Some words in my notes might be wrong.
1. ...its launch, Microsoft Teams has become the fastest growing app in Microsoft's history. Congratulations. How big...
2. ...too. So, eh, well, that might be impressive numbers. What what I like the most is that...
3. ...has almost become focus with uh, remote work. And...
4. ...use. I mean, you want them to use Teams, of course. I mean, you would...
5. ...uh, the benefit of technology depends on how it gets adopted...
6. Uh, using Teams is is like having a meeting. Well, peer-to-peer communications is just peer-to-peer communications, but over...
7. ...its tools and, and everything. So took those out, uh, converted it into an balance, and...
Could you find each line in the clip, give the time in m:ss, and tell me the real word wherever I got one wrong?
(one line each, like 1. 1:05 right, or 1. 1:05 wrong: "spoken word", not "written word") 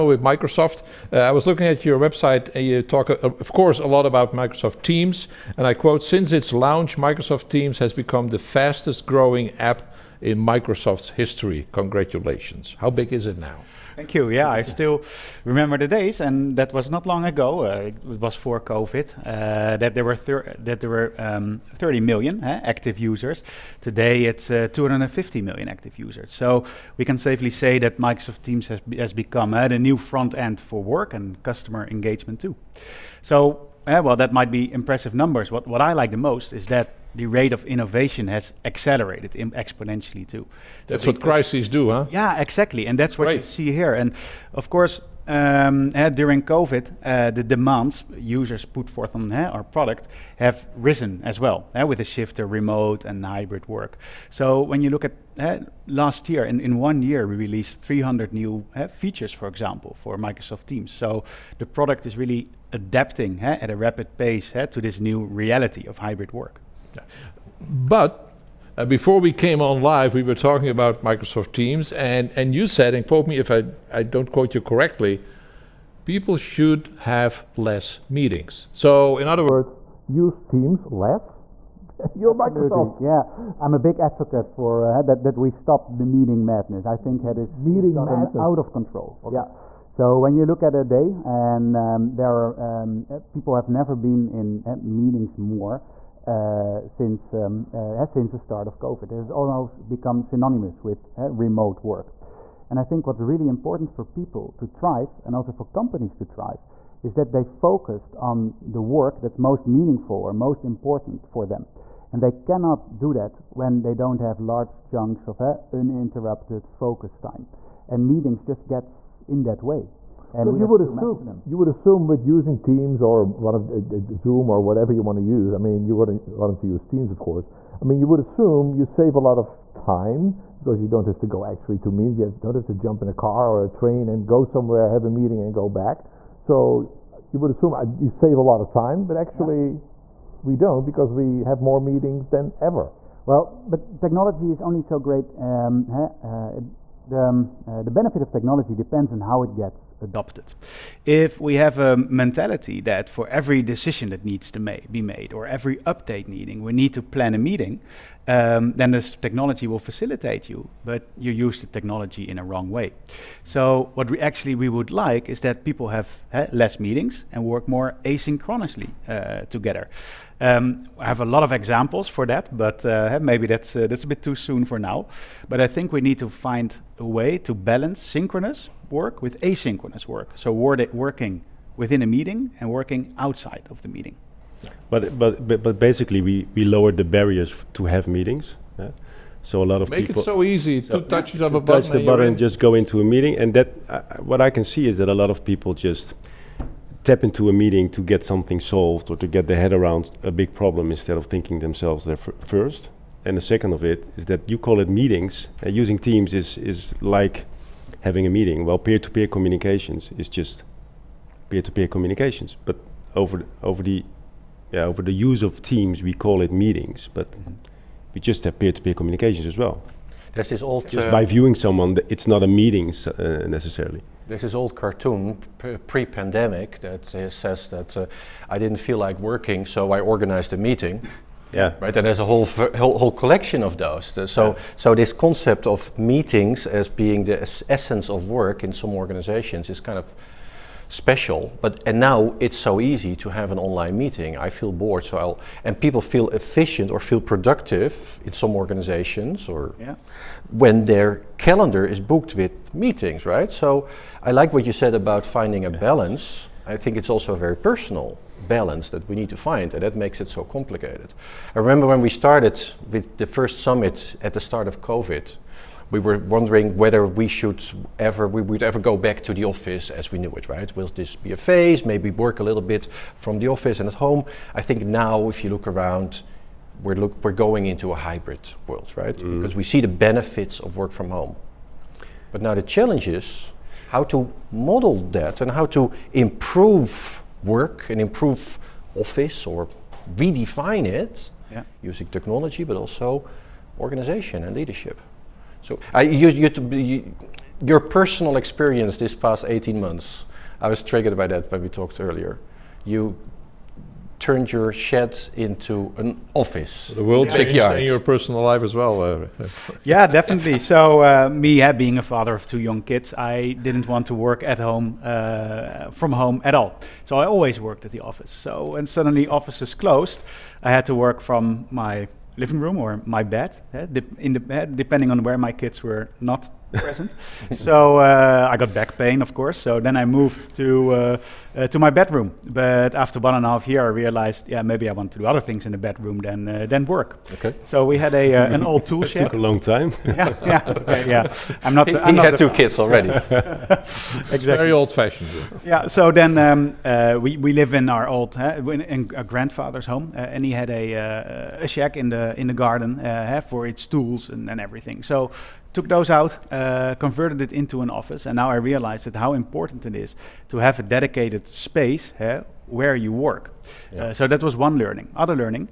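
1. 0:06 right
2. 0:32 right
3. 1:39 wrong: "synonymous", not "focus"
4. 2:05 right
5. 2:27 right
6. 3:25 right
7. 5:53 wrong: "office", not "balance".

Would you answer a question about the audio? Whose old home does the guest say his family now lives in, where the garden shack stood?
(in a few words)
grandfather's.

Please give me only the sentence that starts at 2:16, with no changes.
So you would assume uh, you save a lot of time, but actually.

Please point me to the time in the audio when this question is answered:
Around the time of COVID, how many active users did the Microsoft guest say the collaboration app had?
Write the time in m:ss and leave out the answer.
0:21.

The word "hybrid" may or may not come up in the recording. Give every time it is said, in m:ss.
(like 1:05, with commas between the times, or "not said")
0:53, 1:05, 4:37.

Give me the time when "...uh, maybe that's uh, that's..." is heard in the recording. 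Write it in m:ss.
2:52.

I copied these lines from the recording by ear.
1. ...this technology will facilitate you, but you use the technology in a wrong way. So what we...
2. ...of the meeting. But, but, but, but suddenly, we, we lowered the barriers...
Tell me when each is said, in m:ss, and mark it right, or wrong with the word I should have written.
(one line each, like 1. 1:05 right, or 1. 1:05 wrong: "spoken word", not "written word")
1. 2:38 right
2. 3:03 wrong: "basically", not "suddenly".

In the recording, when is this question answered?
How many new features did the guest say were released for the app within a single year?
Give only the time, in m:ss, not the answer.
0:57.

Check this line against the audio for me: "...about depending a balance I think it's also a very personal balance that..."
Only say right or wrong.
wrong.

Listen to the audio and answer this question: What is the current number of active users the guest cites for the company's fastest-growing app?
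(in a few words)
250 million.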